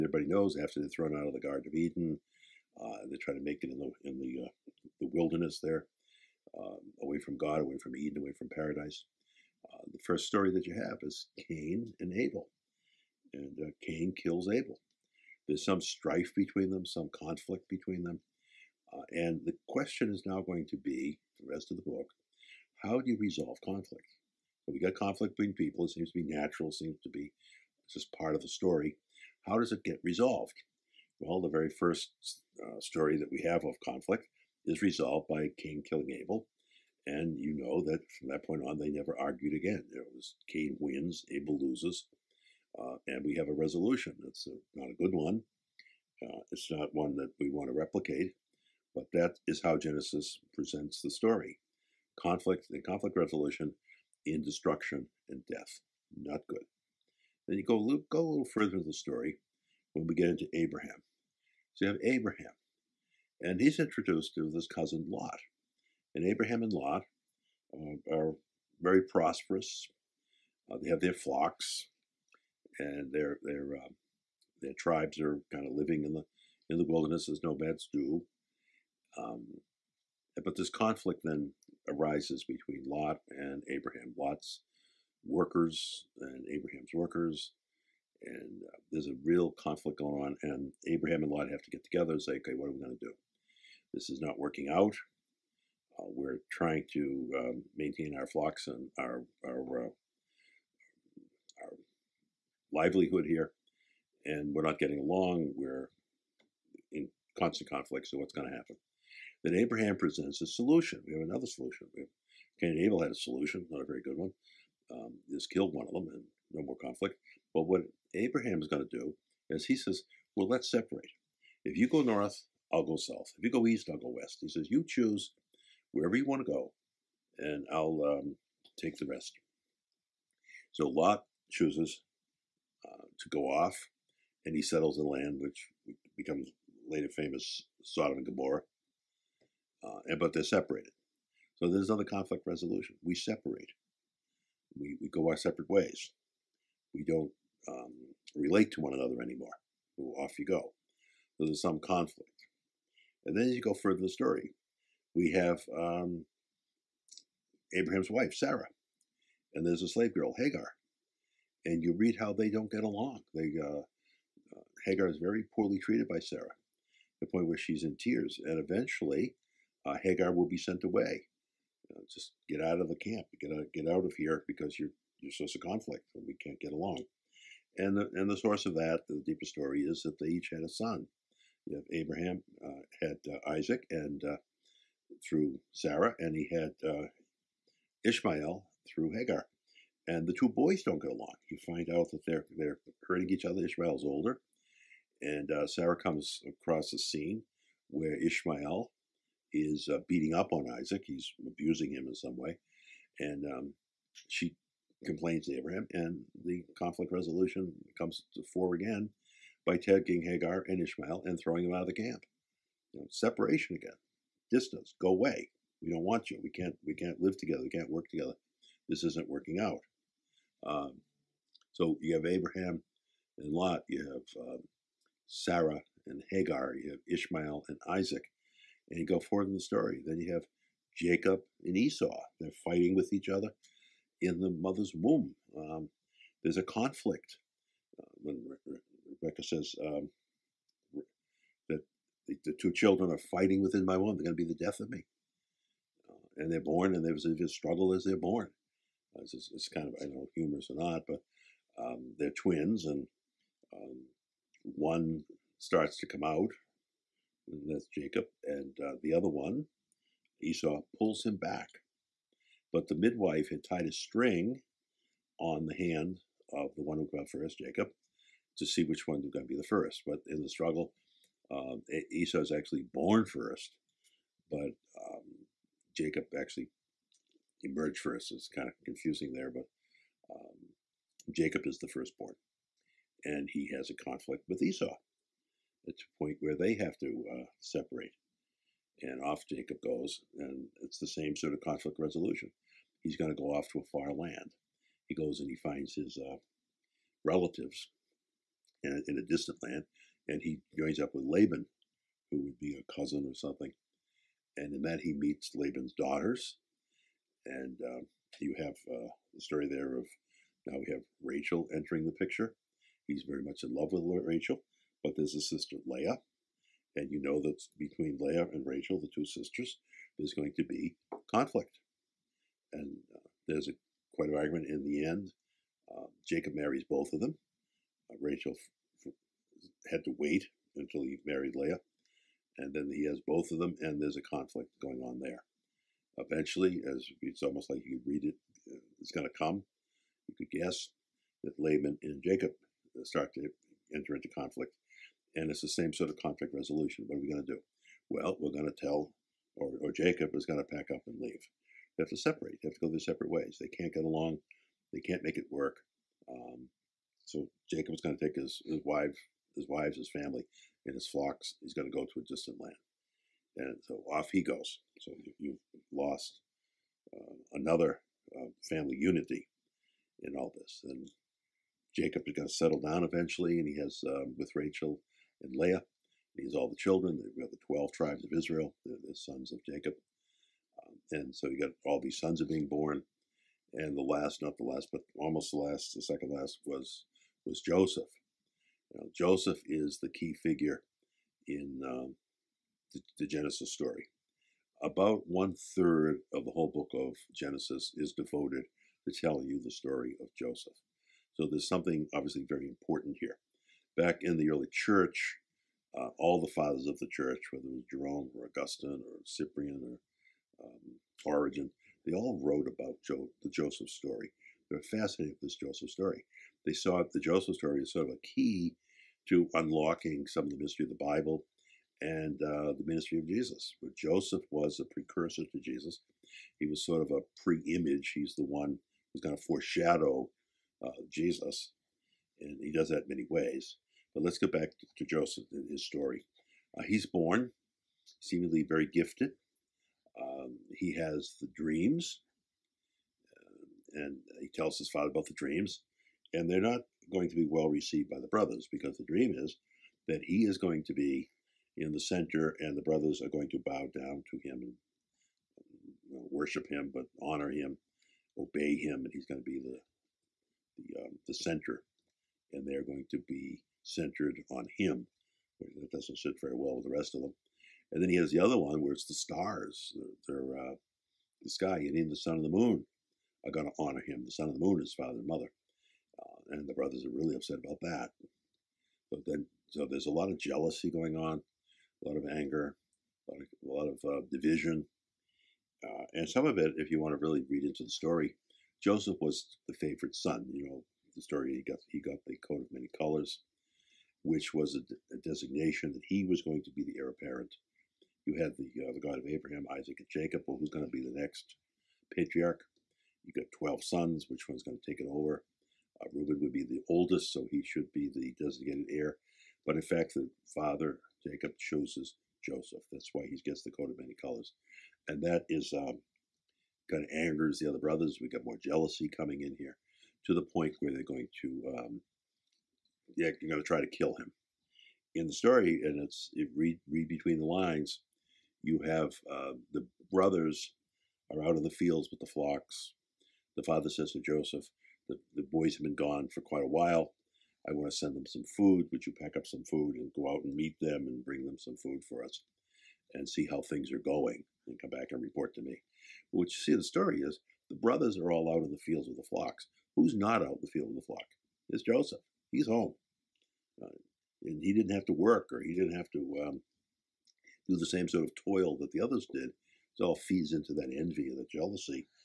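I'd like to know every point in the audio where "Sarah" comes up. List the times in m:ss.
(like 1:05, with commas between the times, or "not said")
2:38, 2:46, 3:05, 3:15, 3:45.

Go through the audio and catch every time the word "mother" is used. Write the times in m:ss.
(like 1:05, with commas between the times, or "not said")
3:54, 7:55.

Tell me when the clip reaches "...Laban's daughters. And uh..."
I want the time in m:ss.
5:05.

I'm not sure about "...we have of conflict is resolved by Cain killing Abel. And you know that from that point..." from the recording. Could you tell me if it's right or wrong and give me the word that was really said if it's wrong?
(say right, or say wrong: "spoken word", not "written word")
right.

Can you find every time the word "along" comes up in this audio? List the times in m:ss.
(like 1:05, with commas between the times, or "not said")
1:44, 2:42, 2:56, 3:11, 5:54.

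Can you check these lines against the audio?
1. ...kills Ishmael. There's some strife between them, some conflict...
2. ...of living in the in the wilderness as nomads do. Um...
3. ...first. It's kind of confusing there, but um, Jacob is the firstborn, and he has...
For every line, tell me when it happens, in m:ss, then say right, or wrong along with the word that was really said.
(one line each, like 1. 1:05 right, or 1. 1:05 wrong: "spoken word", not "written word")
1. 0:14 wrong: "Abel", not "Ishmael"
2. 1:15 right
3. 4:37 right.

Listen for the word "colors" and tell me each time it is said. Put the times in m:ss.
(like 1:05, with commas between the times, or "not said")
8:12, 8:34.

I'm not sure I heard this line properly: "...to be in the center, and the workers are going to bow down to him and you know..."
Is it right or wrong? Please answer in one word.
wrong.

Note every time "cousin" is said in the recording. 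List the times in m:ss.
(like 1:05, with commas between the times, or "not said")
1:04, 5:02.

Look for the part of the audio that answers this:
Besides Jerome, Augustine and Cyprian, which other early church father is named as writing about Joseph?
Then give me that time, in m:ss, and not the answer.
6:51.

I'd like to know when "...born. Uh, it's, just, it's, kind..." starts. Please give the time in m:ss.
4:08.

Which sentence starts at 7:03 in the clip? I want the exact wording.
But Joseph was a precursor to Jesus.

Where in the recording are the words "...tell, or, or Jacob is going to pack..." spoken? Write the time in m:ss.
5:48.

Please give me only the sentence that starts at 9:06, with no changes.
But what you see in the story is the brothers are all out in the fields with the flocks.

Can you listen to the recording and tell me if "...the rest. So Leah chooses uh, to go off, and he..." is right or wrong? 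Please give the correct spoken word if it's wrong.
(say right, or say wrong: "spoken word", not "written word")
wrong: "Lot", not "Leah".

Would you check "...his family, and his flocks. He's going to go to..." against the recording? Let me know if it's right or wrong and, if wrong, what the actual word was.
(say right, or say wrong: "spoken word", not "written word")
right.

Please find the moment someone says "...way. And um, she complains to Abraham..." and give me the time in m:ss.
3:22.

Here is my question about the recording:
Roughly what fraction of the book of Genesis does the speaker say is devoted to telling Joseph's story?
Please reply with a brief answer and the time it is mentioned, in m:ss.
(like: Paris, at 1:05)
one third, at 6:35.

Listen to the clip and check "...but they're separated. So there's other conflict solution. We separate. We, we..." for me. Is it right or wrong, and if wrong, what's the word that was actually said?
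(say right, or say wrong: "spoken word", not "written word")
wrong: "resolution", not "solution".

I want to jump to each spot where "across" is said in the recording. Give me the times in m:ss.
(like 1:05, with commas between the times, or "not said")
3:16.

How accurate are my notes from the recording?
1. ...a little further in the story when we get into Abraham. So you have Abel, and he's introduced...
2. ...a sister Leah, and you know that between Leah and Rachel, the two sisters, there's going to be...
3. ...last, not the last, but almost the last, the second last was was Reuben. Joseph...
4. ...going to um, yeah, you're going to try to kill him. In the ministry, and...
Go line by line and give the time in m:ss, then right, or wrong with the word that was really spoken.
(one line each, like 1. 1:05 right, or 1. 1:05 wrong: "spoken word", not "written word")
1. 0:58 wrong: "Abraham", not "Abel"
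2. 5:15 right
3. 6:24 wrong: "Joseph", not "Reuben"
4. 8:41 wrong: "story", not "ministry".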